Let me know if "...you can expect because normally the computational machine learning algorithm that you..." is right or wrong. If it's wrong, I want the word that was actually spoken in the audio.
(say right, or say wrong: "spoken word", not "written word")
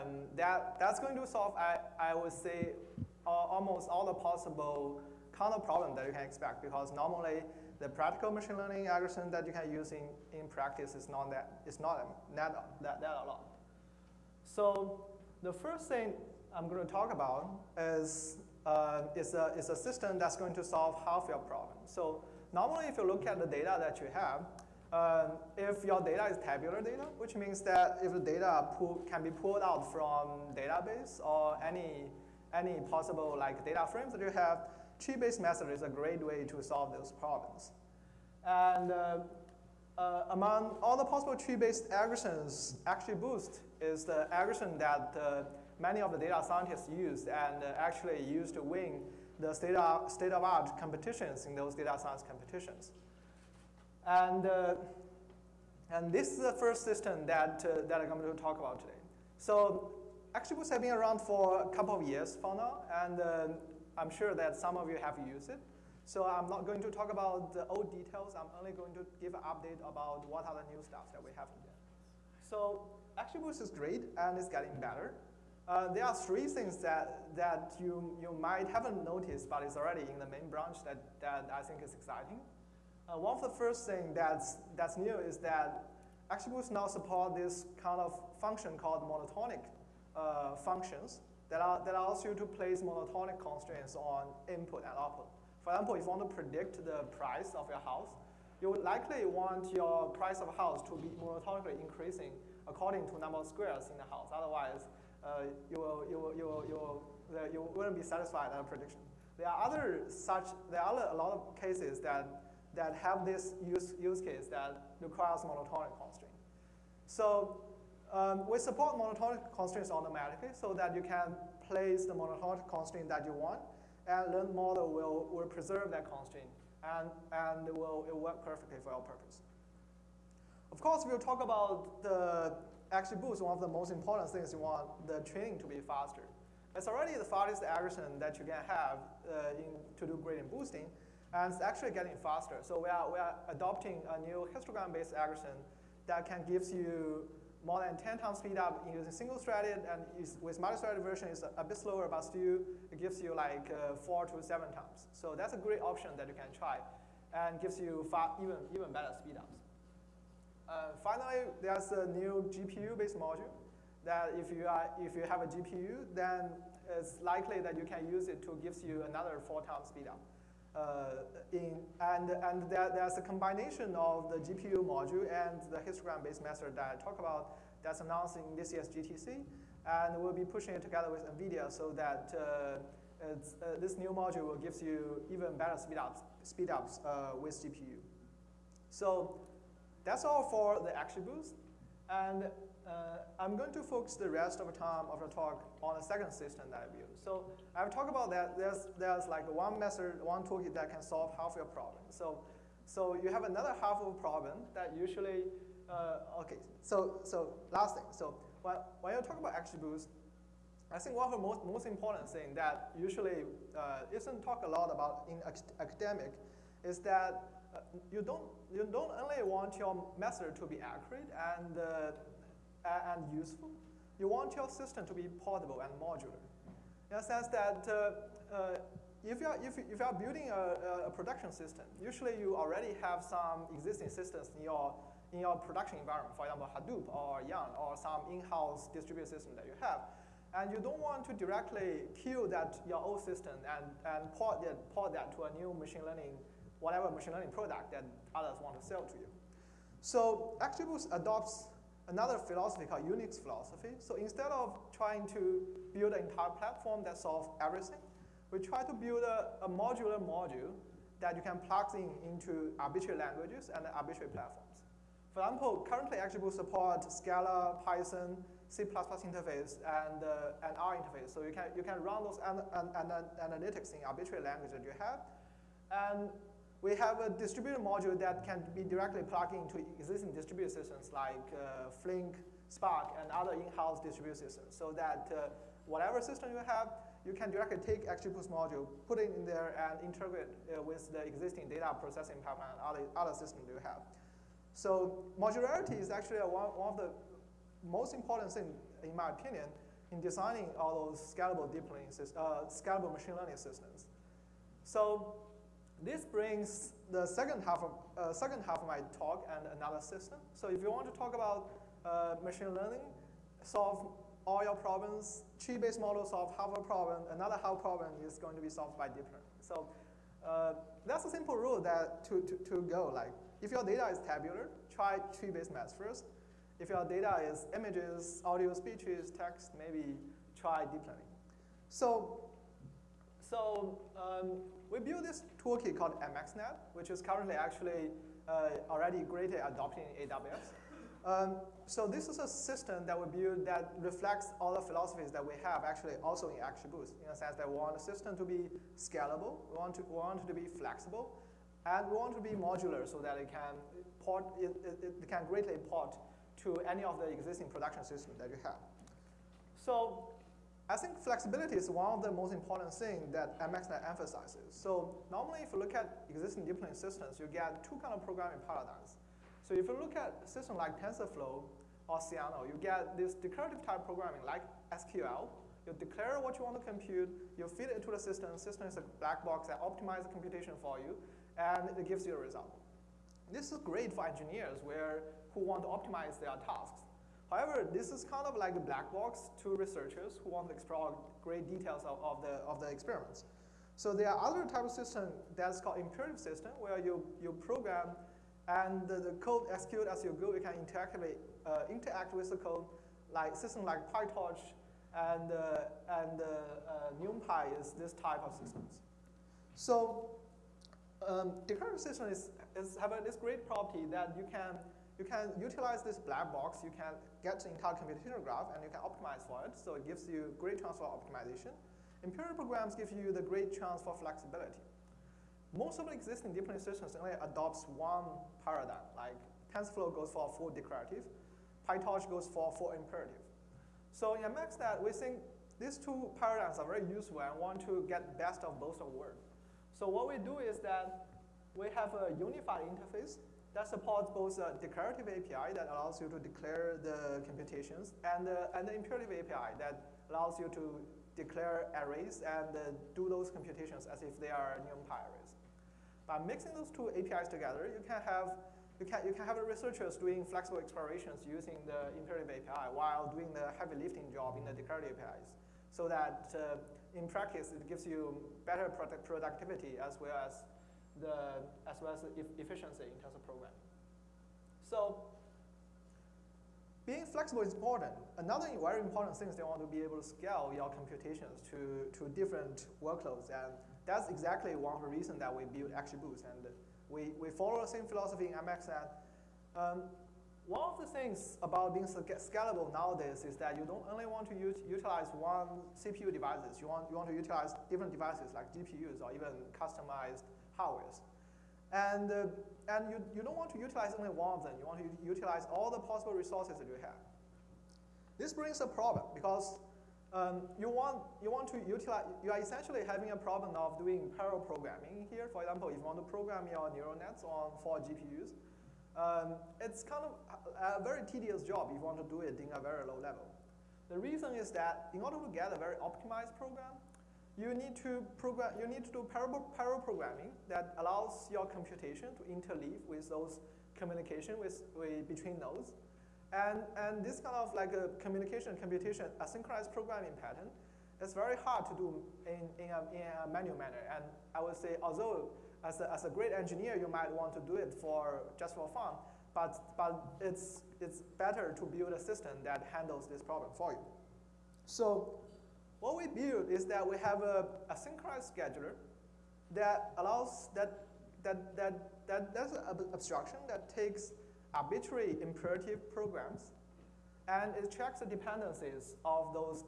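wrong: "practical", not "computational".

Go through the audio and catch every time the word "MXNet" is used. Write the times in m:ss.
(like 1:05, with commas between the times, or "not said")
5:36, 6:03, 7:14.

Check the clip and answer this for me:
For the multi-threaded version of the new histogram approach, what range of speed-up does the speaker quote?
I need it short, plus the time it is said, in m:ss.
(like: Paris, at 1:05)
4 to 7 times, at 2:33.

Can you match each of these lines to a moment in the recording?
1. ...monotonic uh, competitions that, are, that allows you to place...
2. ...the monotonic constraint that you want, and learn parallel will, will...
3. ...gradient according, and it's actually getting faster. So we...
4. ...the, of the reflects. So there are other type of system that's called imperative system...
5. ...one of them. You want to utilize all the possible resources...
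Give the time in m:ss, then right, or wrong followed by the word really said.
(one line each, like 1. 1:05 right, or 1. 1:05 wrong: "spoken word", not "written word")
1. 1:29 wrong: "functions", not "competitions"
2. 2:02 wrong: "model", not "parallel"
3. 2:20 wrong: "boosting", not "according"
4. 6:32 wrong: "experiments", not "reflects"
5. 8:24 right.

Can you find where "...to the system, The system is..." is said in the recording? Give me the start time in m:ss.
6:18.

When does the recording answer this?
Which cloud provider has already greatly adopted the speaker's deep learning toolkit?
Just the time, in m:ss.
5:40.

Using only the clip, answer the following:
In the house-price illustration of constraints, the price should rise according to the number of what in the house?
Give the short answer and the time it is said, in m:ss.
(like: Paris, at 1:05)
squares, at 1:43.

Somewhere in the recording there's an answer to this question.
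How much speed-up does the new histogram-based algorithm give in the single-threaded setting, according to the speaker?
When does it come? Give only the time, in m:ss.
2:27.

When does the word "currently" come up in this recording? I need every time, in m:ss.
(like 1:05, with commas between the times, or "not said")
4:25, 5:37.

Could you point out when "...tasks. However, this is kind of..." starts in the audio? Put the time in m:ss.
6:26.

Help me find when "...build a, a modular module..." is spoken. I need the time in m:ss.
4:18.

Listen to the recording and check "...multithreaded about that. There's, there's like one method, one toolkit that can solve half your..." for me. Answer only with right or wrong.
wrong.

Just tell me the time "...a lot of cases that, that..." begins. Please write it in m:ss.
1:51.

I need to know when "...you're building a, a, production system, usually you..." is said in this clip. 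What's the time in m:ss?
3:49.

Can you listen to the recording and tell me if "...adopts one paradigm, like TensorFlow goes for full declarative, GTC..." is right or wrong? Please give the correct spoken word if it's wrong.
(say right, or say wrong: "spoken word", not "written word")
wrong: "PyTorch", not "GTC".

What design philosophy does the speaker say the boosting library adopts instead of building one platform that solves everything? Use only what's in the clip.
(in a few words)
Unix philosophy.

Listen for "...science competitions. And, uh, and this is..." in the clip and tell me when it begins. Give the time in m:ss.
0:51.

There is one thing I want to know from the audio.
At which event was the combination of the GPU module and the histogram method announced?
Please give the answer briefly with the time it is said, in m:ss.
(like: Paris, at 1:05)
GTC, at 2:58.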